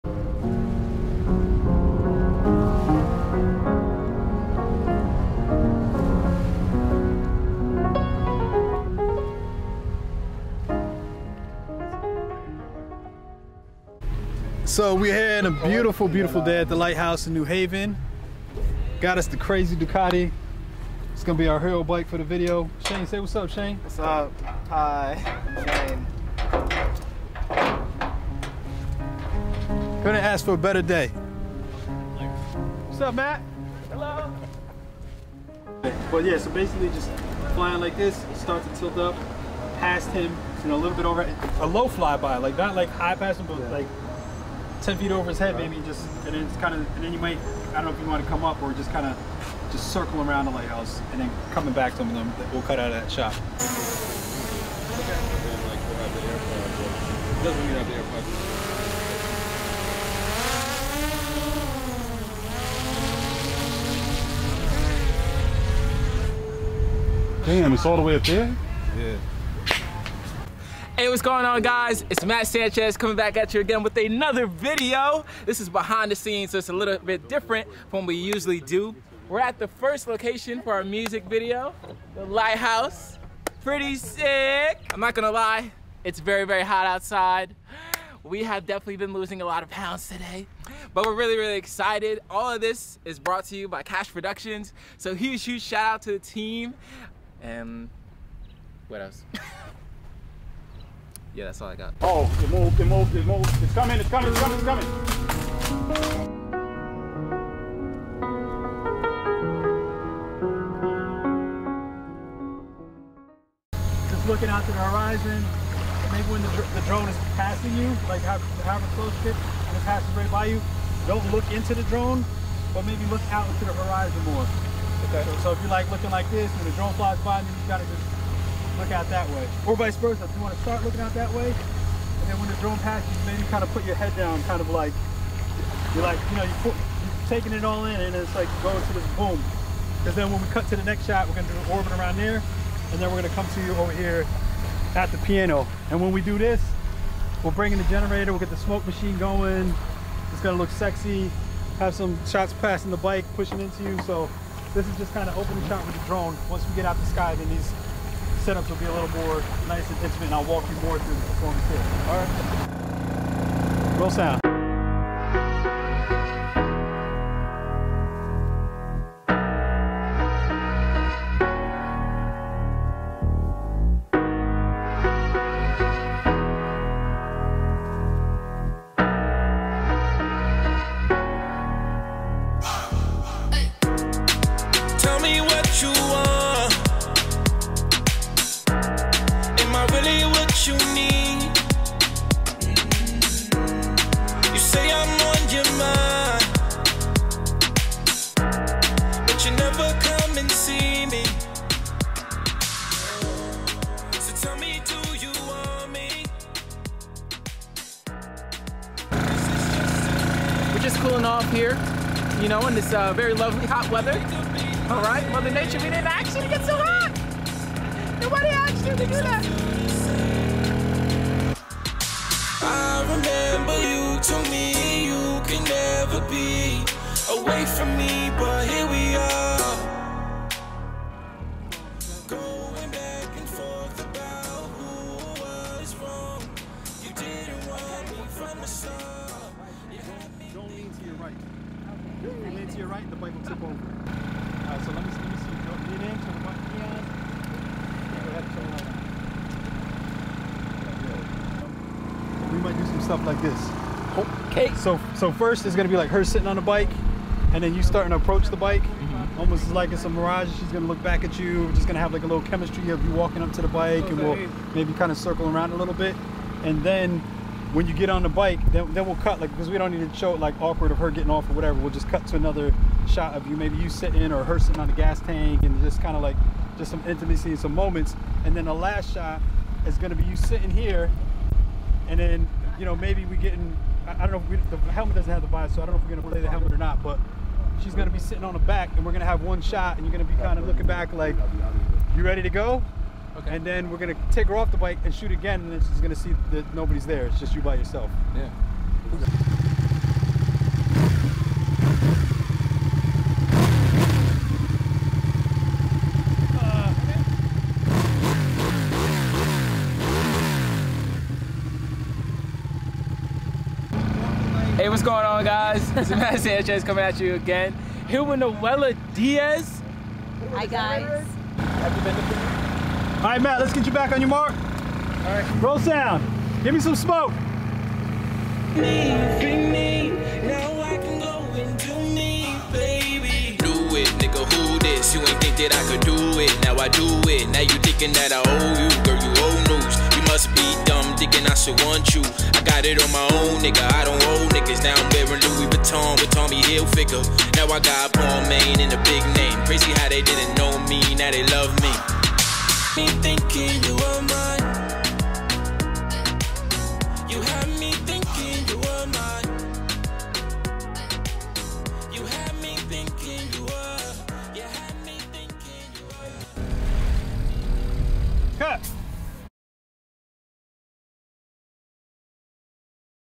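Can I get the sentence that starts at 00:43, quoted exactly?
like 10 feet over his head, right.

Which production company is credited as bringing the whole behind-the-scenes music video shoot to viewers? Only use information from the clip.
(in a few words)
Cash Productions.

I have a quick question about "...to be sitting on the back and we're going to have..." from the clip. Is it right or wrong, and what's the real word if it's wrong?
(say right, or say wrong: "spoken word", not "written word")
right.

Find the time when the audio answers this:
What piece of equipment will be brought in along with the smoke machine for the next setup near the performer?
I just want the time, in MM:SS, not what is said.
02:27.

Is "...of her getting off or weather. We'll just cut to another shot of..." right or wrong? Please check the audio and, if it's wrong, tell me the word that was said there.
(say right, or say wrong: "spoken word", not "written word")
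wrong: "whatever", not "weather".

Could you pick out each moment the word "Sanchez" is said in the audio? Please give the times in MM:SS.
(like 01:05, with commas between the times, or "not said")
01:12, 05:16.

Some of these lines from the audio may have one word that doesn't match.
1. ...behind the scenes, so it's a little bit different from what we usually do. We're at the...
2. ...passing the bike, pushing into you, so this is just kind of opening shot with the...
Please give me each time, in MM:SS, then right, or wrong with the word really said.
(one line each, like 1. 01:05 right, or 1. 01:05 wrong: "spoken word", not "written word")
1. 01:15 right
2. 02:32 right.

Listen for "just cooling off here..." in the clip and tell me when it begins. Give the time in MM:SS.
03:30.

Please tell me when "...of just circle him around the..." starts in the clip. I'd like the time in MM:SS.
00:49.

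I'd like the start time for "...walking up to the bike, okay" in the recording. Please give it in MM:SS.
04:23.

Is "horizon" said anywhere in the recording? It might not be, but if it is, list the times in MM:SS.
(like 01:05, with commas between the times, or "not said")
01:54, 02:03.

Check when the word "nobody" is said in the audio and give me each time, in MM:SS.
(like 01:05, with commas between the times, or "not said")
03:38, 04:56.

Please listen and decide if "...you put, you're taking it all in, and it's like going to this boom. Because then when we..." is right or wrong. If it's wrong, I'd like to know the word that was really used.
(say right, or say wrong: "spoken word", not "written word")
right.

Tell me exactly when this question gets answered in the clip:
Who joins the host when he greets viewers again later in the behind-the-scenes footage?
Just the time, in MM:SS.
05:18.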